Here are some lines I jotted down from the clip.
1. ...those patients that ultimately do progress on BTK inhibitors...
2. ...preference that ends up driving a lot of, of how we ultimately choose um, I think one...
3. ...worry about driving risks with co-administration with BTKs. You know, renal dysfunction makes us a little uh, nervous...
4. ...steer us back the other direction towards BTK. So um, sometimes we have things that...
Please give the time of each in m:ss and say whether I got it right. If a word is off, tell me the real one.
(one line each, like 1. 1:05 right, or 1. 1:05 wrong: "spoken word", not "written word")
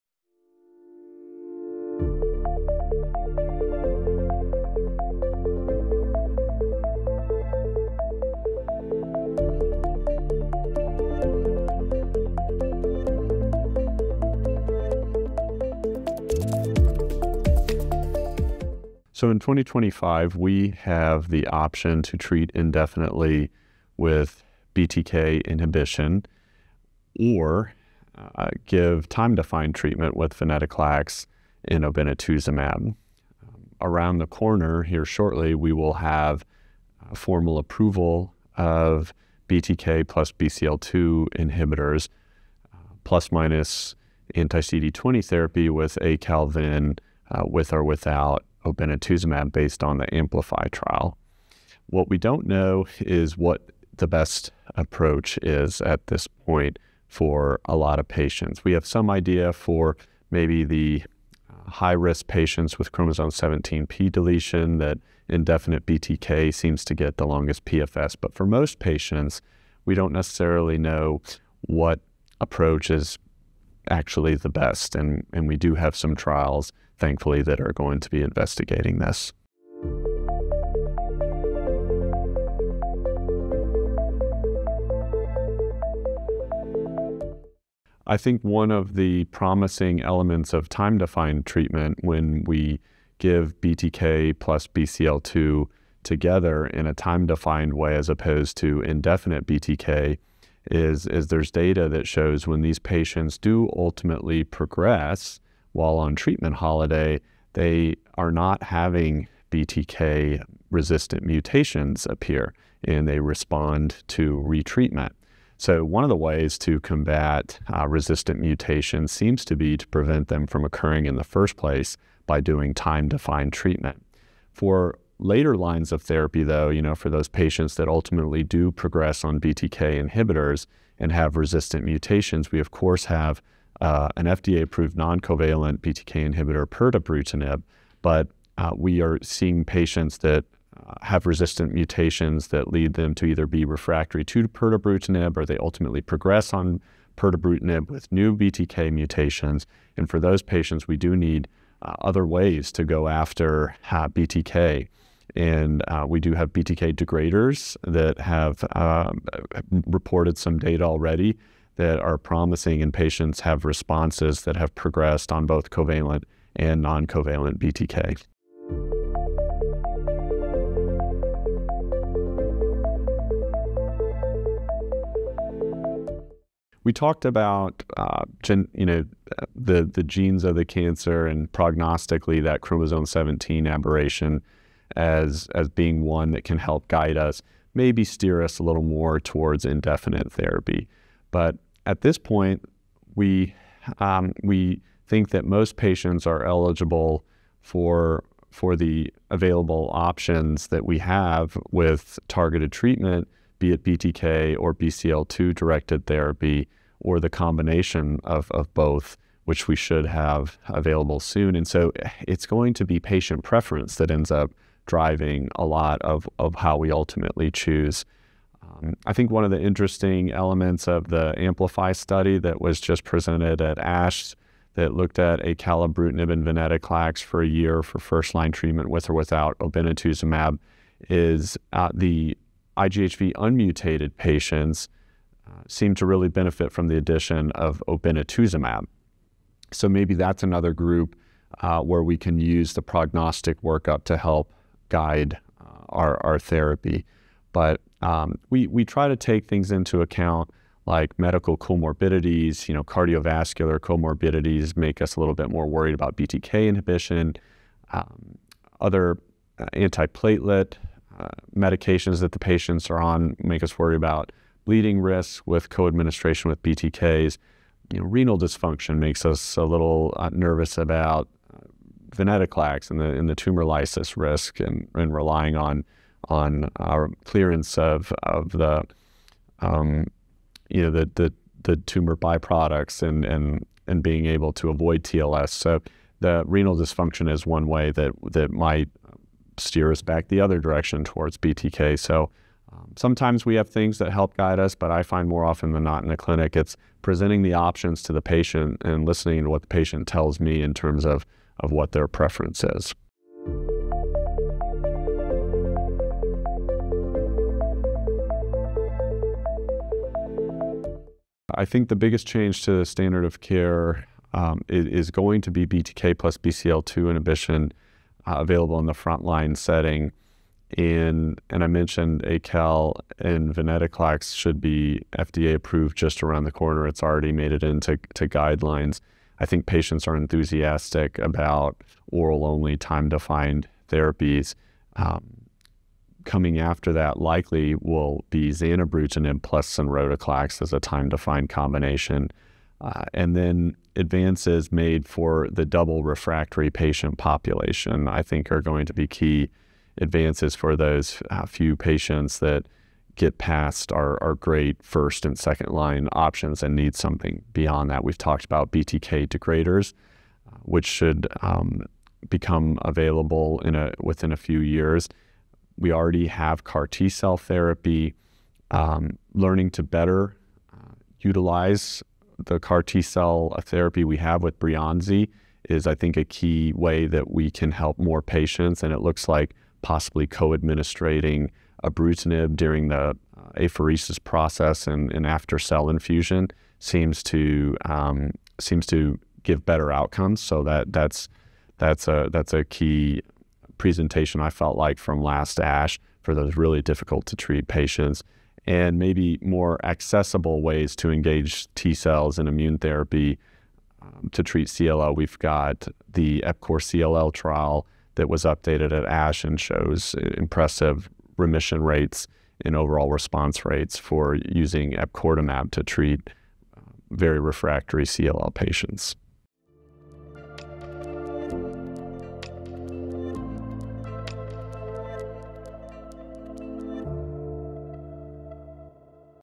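1. 2:07 right
2. 3:33 right
3. 4:23 wrong: "bleeding", not "driving"
4. 4:49 right.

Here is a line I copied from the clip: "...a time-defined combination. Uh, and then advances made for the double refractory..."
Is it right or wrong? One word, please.
right.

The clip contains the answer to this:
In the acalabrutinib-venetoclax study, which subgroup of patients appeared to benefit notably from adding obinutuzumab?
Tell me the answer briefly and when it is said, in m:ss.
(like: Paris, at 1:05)
IGHV unmutated, at 3:52.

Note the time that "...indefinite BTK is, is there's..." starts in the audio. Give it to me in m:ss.
1:38.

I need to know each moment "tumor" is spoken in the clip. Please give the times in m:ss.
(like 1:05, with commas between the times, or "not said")
4:33, 4:41.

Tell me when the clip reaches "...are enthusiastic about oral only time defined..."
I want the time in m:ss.
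5:30.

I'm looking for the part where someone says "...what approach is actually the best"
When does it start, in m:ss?
1:11.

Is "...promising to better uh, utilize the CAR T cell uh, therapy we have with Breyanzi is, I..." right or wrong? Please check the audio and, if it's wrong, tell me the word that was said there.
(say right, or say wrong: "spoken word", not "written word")
wrong: "learning", not "promising".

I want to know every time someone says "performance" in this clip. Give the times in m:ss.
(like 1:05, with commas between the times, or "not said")
not said.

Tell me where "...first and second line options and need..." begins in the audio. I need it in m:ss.
5:54.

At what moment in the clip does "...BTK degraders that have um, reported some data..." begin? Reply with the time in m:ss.
2:36.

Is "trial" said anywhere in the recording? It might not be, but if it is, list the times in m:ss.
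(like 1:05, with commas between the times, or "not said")
0:50, 1:16, 6:47.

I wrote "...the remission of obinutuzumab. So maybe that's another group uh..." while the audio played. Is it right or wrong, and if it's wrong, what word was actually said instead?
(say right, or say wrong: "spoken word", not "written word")
wrong: "addition", not "remission".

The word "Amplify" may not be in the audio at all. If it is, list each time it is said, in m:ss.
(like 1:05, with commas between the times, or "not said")
0:50, 3:41.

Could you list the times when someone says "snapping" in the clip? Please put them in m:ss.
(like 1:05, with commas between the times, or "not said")
not said.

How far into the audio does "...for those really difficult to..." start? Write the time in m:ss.
6:36.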